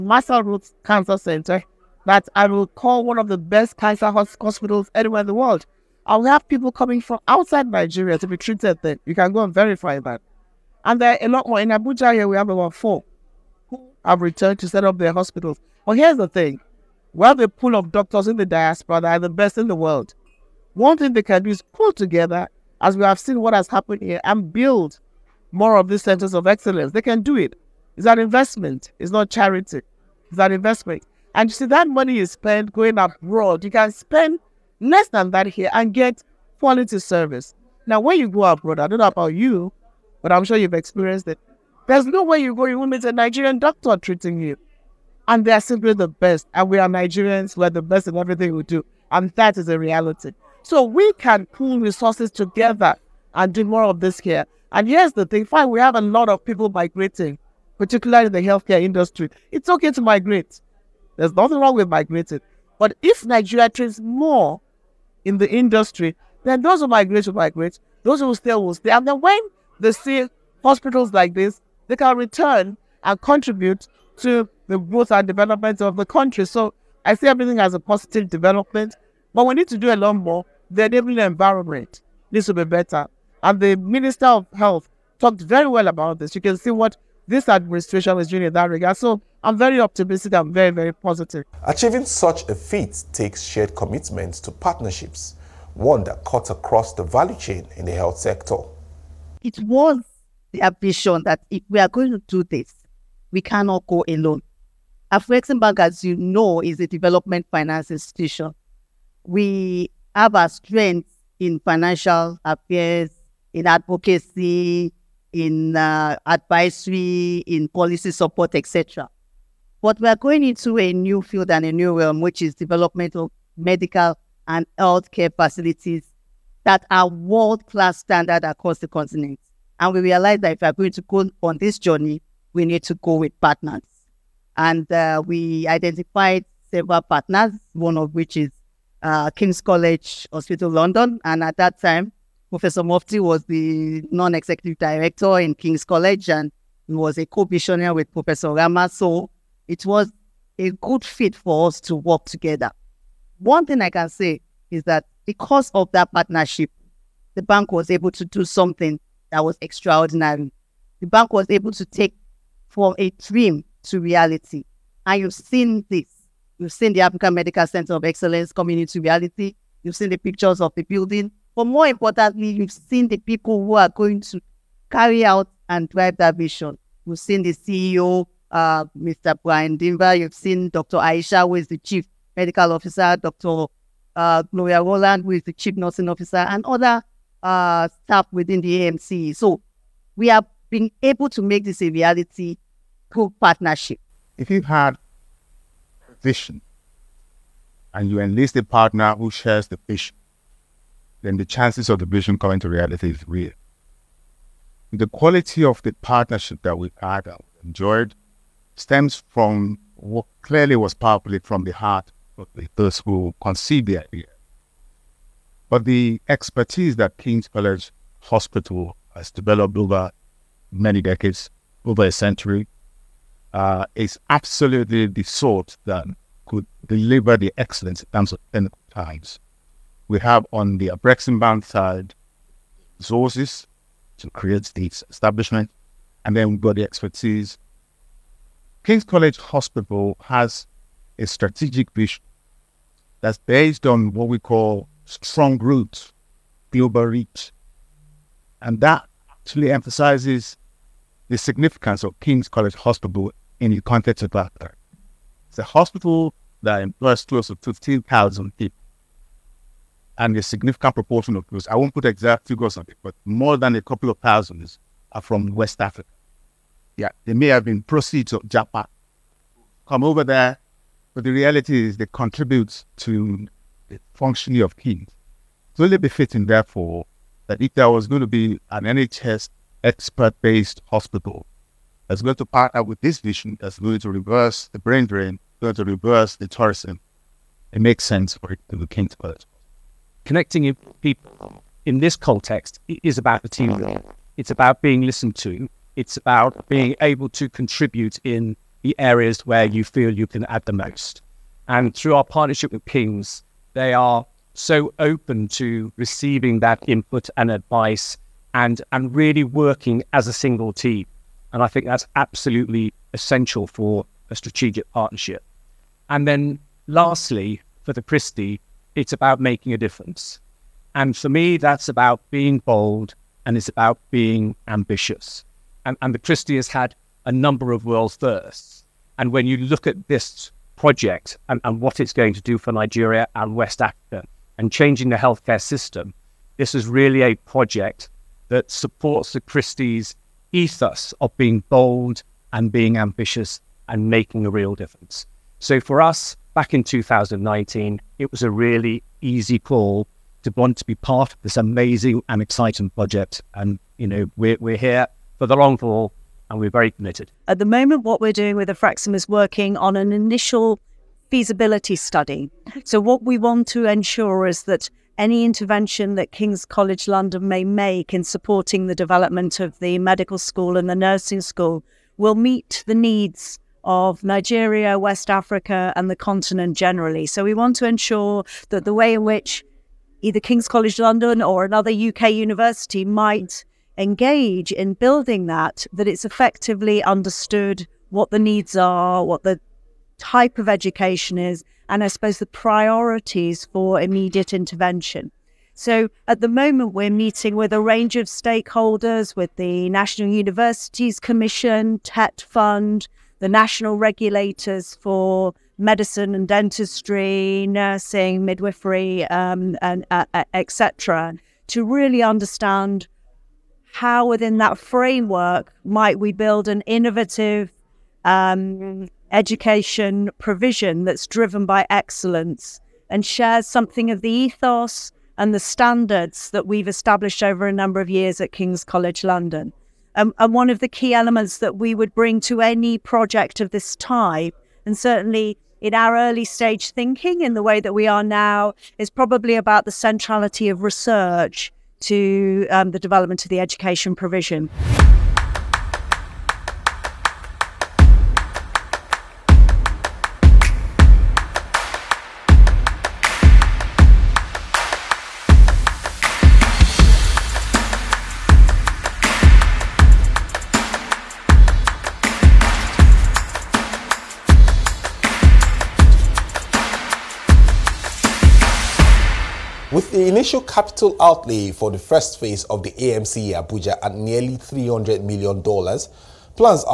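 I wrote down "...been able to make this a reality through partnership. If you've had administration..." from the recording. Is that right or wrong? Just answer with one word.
wrong.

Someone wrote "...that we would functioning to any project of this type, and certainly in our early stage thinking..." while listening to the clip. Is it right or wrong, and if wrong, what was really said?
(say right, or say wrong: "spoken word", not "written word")
wrong: "bring", not "functioning".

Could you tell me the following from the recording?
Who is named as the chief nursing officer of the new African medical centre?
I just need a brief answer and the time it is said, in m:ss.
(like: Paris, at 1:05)
Gloria Roland, at 3:04.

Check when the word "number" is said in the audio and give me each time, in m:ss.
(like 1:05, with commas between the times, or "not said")
5:27, 7:07.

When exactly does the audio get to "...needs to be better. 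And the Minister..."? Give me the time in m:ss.
1:22.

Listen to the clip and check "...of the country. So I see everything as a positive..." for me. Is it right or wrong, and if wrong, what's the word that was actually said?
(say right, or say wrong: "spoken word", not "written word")
right.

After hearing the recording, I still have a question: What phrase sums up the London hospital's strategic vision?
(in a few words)
Strong roots, global reach.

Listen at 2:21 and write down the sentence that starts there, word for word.
And at that time, Professor Mufti was the non-executive director in King's College and he was a co-missionary with Professor Rama.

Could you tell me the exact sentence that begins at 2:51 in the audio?
But more importantly, you've seen the people who are going to carry out and drive that vision.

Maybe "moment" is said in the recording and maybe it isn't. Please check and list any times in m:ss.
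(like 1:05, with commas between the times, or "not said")
5:57, 6:36.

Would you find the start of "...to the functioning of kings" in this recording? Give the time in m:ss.
4:32.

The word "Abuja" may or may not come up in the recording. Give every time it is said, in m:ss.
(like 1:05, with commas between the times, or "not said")
0:11, 7:53.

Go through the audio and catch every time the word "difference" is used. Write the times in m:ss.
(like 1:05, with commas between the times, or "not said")
5:19, 5:44.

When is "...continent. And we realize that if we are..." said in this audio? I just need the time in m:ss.
2:08.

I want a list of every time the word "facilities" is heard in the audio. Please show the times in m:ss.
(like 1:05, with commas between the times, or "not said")
2:05.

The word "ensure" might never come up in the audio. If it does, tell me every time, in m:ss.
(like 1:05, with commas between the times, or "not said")
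6:03, 6:17.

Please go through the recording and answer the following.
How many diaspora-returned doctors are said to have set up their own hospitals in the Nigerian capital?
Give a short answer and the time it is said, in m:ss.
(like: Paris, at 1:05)
4, at 0:12.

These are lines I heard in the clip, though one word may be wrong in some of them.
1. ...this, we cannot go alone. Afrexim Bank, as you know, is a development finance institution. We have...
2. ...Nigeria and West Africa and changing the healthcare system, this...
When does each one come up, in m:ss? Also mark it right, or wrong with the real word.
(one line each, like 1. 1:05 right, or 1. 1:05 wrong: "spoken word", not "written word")
1. 1:42 right
2. 5:32 right.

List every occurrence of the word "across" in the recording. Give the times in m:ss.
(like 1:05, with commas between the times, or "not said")
1:36, 2:08.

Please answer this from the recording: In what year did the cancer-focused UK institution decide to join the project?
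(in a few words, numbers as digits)
2019.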